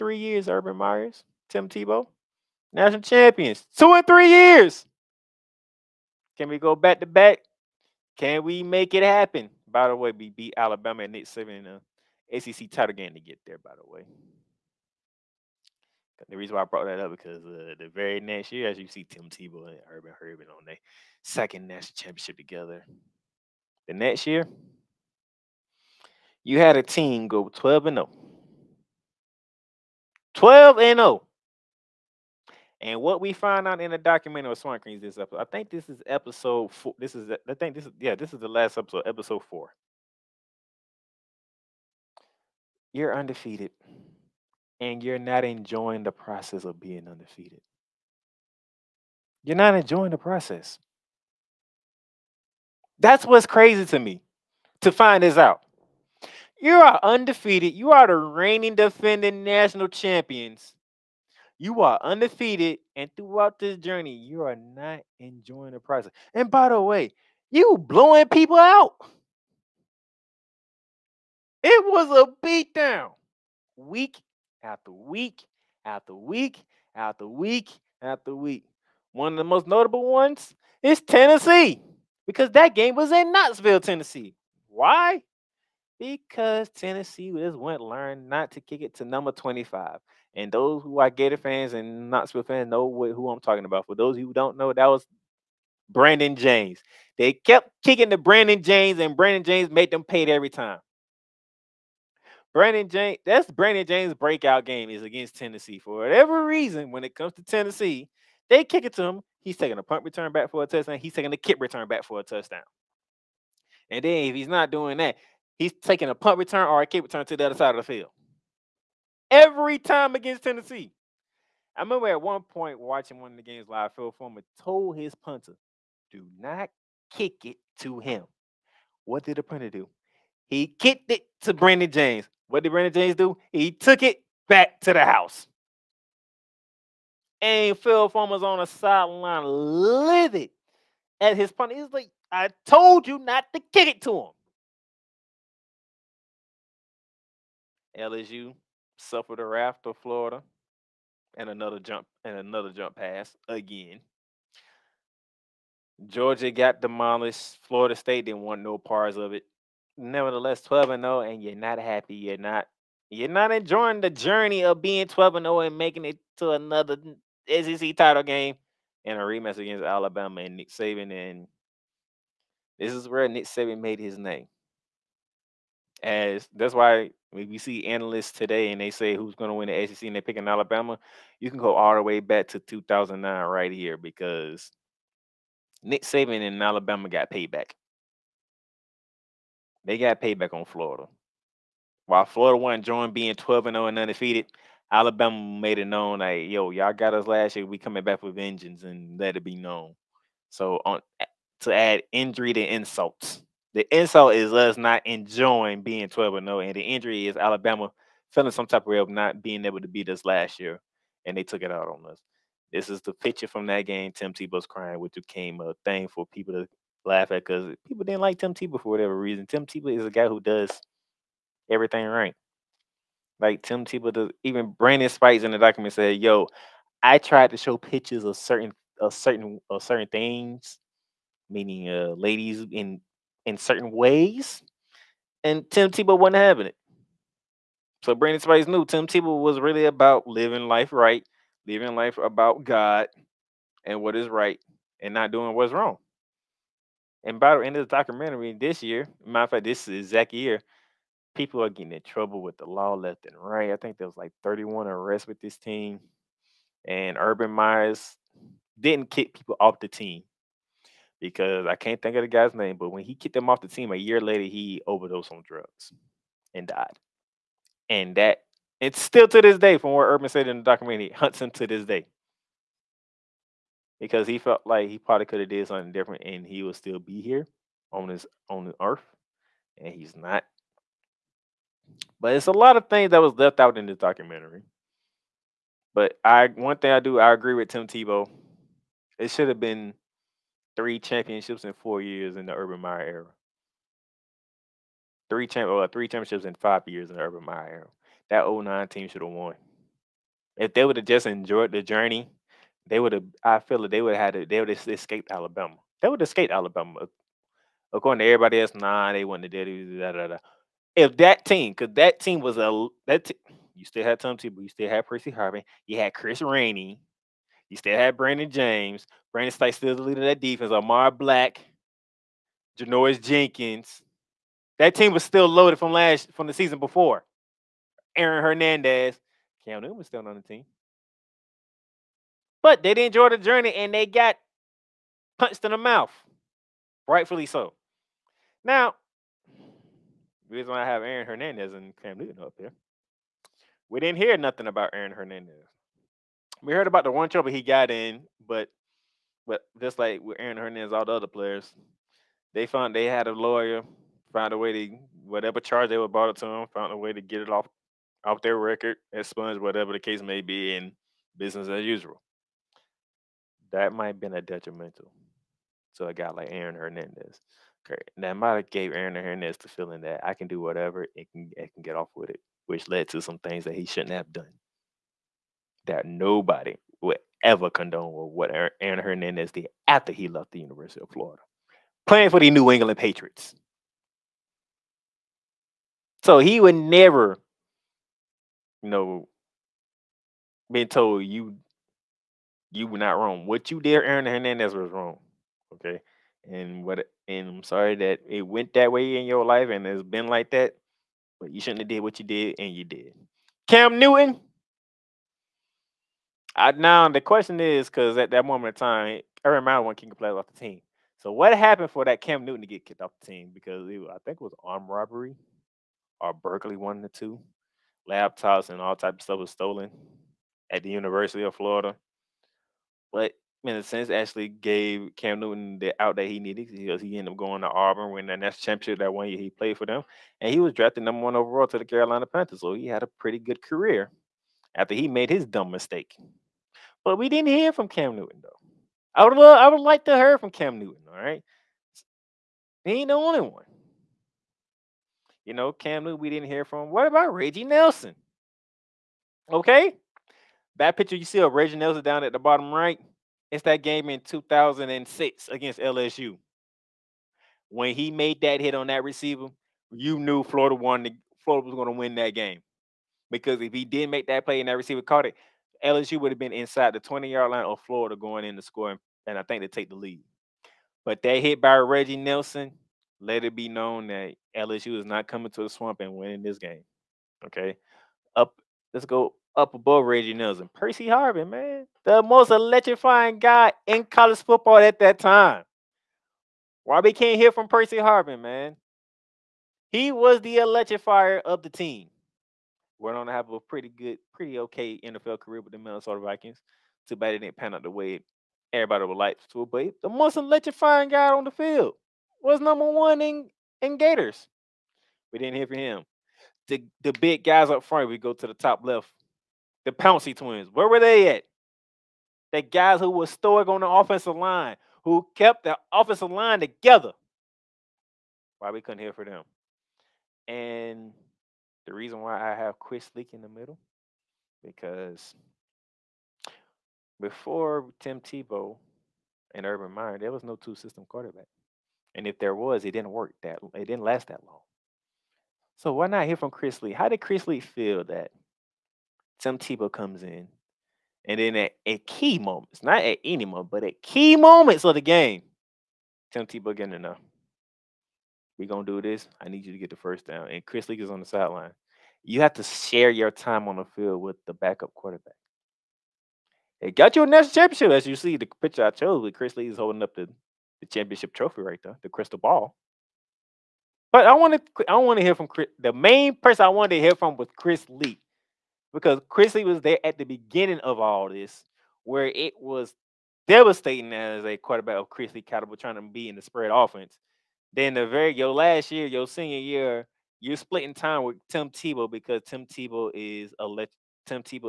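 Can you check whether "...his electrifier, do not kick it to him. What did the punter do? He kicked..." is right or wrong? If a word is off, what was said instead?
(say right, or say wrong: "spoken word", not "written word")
wrong: "punter", not "electrifier".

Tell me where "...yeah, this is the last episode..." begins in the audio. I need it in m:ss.
0:37.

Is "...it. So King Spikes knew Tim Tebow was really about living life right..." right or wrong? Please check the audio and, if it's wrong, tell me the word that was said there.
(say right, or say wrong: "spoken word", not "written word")
wrong: "Brandon", not "King".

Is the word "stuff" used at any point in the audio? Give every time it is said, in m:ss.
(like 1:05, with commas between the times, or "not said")
6:59.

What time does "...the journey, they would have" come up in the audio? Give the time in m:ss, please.
5:01.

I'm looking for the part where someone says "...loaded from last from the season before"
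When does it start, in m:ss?
5:25.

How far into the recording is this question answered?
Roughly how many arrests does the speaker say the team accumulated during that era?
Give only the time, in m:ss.
4:14.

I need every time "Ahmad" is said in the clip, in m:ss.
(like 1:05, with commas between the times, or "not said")
5:20.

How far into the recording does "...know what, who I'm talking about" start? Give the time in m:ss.
1:32.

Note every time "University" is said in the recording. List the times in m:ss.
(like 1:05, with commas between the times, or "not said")
6:20, 7:00.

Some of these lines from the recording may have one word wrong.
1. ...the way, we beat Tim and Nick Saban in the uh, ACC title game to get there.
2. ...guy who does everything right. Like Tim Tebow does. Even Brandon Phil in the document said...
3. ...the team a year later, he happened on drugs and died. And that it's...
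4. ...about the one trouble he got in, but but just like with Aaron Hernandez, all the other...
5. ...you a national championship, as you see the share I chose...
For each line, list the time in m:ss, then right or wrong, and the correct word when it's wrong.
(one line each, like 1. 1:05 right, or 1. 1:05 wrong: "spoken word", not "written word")
1. 0:09 wrong: "Alabama", not "Tim"
2. 3:40 wrong: "Spikes", not "Phil"
3. 4:23 wrong: "overdosed", not "happened"
4. 5:46 right
5. 9:17 wrong: "picture", not "share".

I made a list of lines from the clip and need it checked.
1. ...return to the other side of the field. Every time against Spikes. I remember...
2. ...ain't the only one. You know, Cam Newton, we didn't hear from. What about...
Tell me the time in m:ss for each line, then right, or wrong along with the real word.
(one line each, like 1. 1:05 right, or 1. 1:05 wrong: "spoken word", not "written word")
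1. 1:57 wrong: "Tennessee", not "Spikes"
2. 7:22 right.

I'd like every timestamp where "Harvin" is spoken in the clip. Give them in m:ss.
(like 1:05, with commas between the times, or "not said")
5:15, 8:01, 8:07.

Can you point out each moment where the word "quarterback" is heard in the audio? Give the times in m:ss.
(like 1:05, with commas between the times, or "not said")
8:51, 9:14, 9:34.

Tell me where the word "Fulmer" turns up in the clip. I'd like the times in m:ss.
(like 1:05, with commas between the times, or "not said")
2:04, 2:18.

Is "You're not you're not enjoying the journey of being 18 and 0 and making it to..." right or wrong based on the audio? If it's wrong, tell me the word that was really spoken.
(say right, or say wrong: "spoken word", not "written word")
wrong: "12", not "18".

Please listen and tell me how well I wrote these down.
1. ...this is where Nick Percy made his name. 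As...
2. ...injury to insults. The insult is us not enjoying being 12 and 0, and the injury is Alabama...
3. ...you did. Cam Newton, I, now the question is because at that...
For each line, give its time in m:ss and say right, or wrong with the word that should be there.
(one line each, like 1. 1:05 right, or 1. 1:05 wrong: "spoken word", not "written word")
1. 2:52 wrong: "Saban", not "Percy"
2. 3:22 right
3. 6:42 right.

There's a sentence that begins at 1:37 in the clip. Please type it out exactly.
They kept kicking to Brandon James, and Brandon James made them pay every time.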